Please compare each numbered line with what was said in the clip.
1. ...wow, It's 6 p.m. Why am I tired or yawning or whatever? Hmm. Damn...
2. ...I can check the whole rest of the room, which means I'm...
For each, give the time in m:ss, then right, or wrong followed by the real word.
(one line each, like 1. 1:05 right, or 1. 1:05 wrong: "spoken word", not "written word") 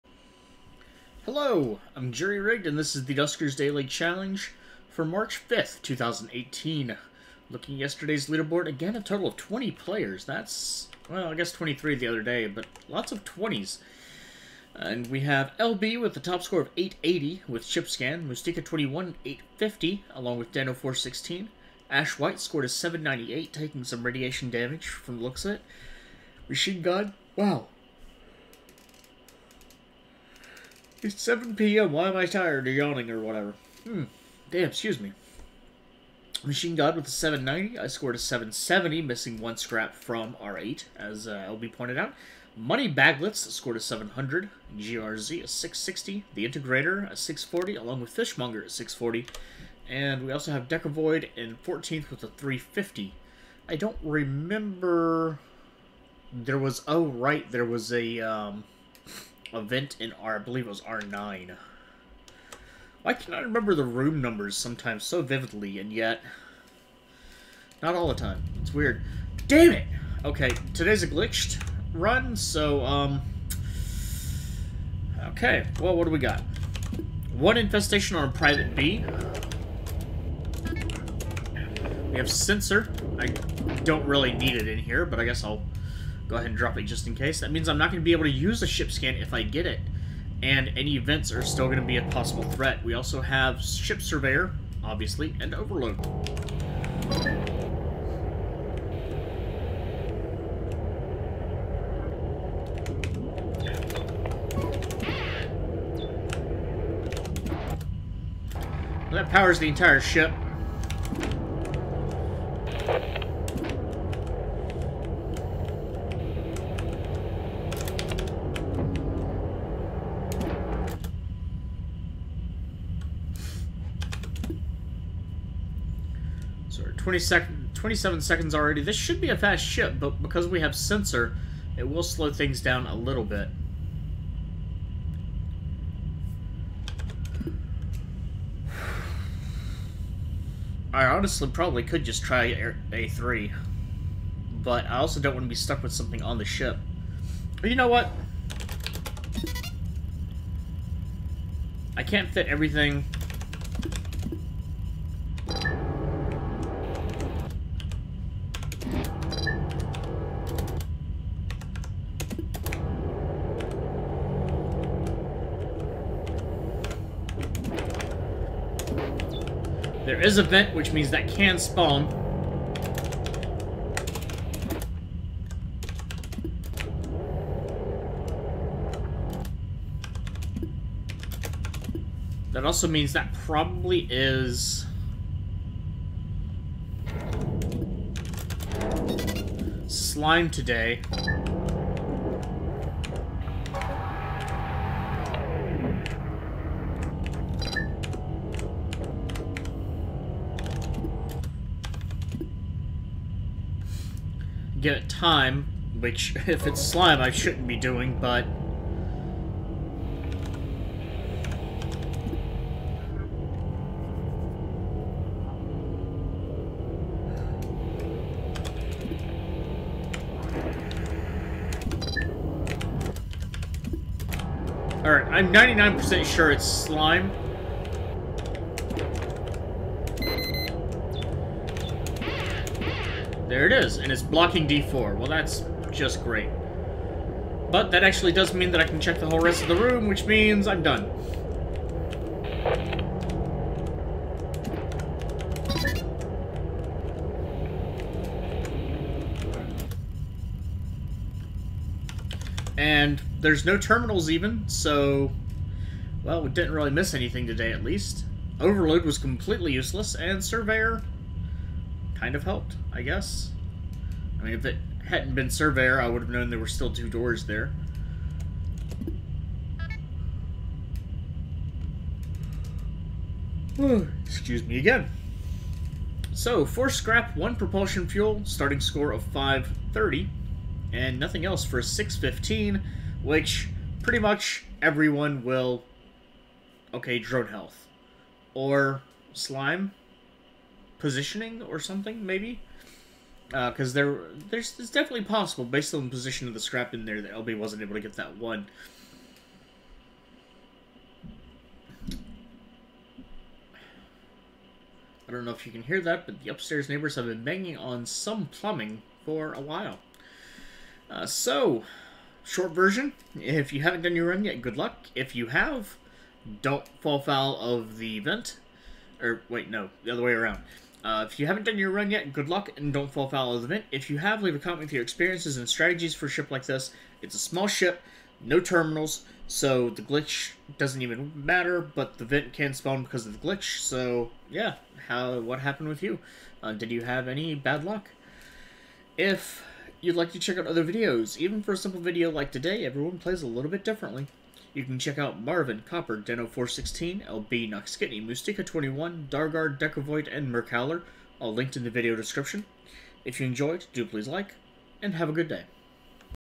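1. 0:27 wrong: "7", not "6"
2. 3:58 right.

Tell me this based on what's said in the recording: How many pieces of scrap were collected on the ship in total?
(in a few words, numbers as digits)
4.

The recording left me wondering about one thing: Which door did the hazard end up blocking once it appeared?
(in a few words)
D4.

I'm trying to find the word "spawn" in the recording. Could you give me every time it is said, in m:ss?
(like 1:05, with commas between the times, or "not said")
2:51, 5:32.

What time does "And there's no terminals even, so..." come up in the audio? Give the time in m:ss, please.
4:12.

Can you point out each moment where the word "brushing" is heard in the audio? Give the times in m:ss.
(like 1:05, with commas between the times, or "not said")
not said.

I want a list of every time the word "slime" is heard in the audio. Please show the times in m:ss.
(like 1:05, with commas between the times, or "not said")
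3:09, 3:26, 3:46, 4:49.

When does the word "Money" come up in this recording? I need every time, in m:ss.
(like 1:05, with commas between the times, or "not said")
0:42.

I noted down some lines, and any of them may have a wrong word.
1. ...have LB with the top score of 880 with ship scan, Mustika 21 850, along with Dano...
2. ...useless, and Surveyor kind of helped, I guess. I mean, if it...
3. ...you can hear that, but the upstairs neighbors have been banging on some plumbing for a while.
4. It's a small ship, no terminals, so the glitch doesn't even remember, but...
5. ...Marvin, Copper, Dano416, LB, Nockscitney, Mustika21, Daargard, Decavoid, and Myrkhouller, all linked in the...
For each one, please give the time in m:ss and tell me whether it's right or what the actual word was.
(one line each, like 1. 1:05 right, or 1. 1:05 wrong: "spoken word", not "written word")
1. 0:15 right
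2. 4:19 right
3. 5:05 right
4. 5:27 wrong: "matter", not "remember"
5. 5:45 right.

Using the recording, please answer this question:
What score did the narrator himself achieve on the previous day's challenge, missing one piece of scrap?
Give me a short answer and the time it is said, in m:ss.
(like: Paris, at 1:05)
770, at 0:37.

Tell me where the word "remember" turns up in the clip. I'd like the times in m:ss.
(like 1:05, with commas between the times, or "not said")
0:54, 1:03.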